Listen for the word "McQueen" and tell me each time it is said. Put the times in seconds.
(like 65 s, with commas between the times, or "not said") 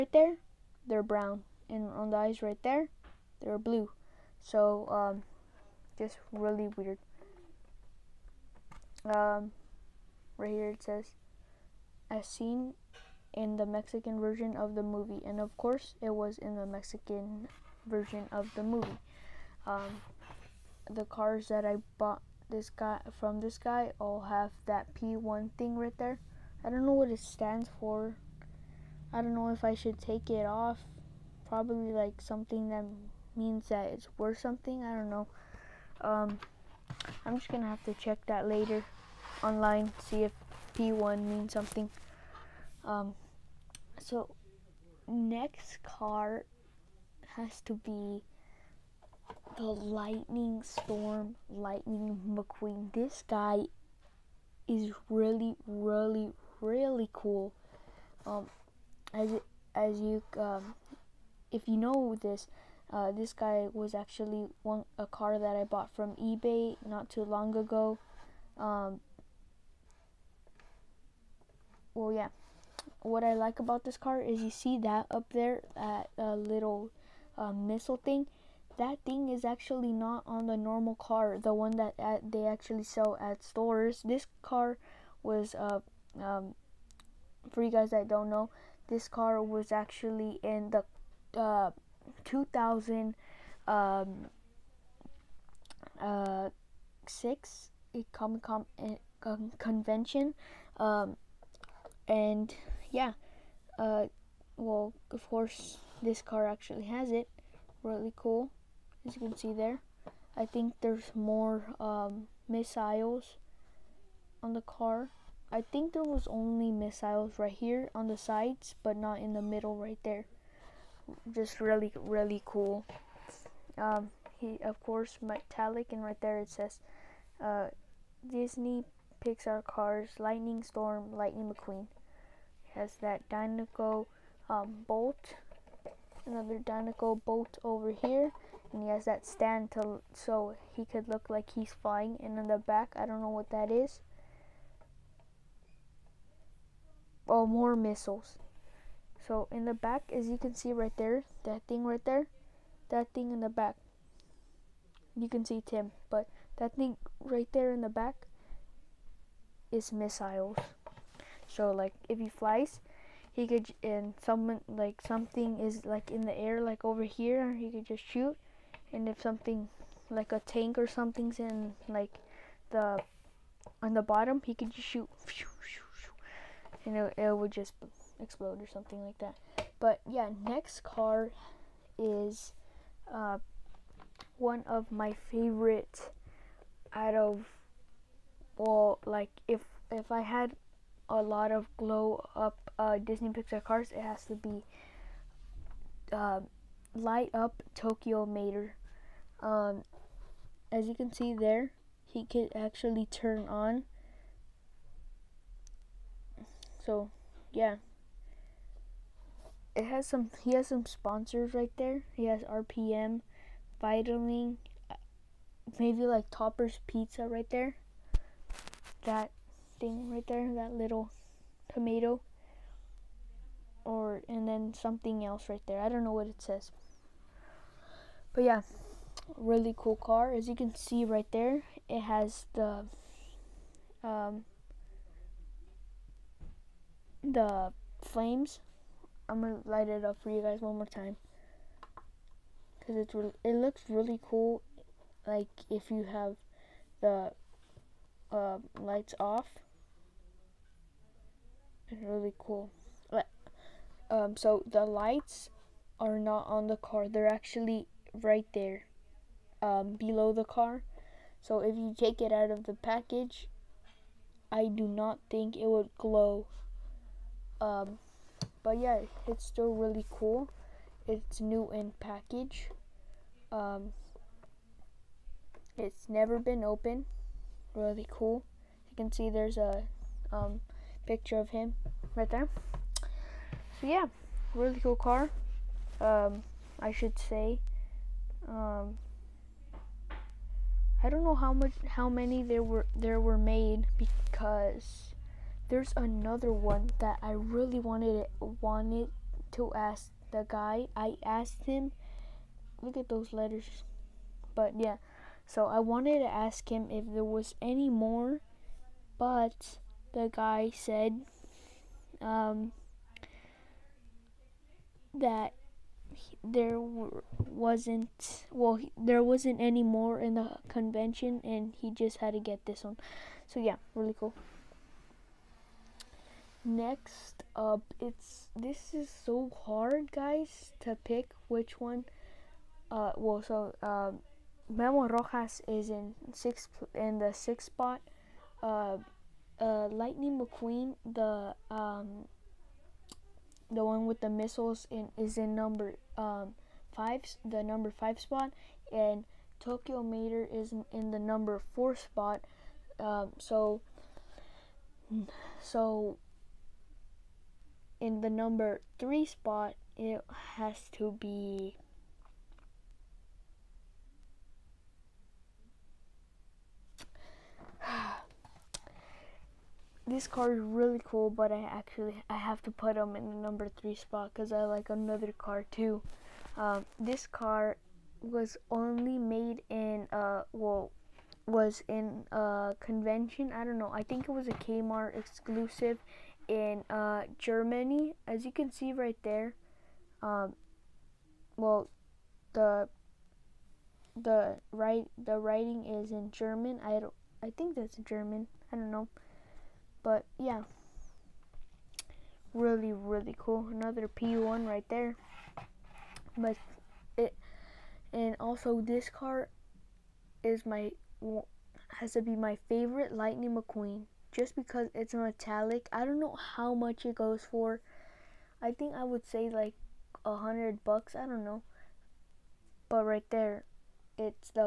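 52 s, 131 s, 340 s, 413 s.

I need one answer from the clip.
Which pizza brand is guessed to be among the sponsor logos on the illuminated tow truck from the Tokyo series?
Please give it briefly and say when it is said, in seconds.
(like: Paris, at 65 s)
Topper's Pizza, at 216 s.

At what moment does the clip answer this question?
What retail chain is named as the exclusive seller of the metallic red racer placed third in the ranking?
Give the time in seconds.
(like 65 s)
384 s.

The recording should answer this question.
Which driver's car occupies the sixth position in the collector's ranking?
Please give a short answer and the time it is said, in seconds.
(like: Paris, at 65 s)
Memo Rojas, at 334 s.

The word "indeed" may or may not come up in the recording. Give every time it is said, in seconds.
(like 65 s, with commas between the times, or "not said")
not said.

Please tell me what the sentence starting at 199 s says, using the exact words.
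Um, as you can see there, he can actually turn on.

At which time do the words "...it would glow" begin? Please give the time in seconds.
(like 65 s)
265 s.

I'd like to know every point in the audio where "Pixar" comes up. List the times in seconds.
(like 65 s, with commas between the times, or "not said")
129 s, 193 s.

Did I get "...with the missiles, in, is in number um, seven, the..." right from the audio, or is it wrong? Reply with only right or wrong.
wrong.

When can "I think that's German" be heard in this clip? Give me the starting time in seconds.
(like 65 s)
397 s.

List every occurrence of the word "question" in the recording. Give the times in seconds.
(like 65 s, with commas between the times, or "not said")
not said.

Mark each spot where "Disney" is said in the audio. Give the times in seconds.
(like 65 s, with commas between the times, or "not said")
128 s, 192 s.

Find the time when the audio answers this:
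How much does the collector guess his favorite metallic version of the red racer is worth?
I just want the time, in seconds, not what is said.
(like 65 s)
420 s.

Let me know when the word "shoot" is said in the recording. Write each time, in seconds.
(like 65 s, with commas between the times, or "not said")
168 s, 174 s.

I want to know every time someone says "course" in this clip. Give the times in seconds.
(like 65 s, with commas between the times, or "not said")
15 s, 105 s, 124 s.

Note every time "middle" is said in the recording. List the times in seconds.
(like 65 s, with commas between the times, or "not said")
119 s.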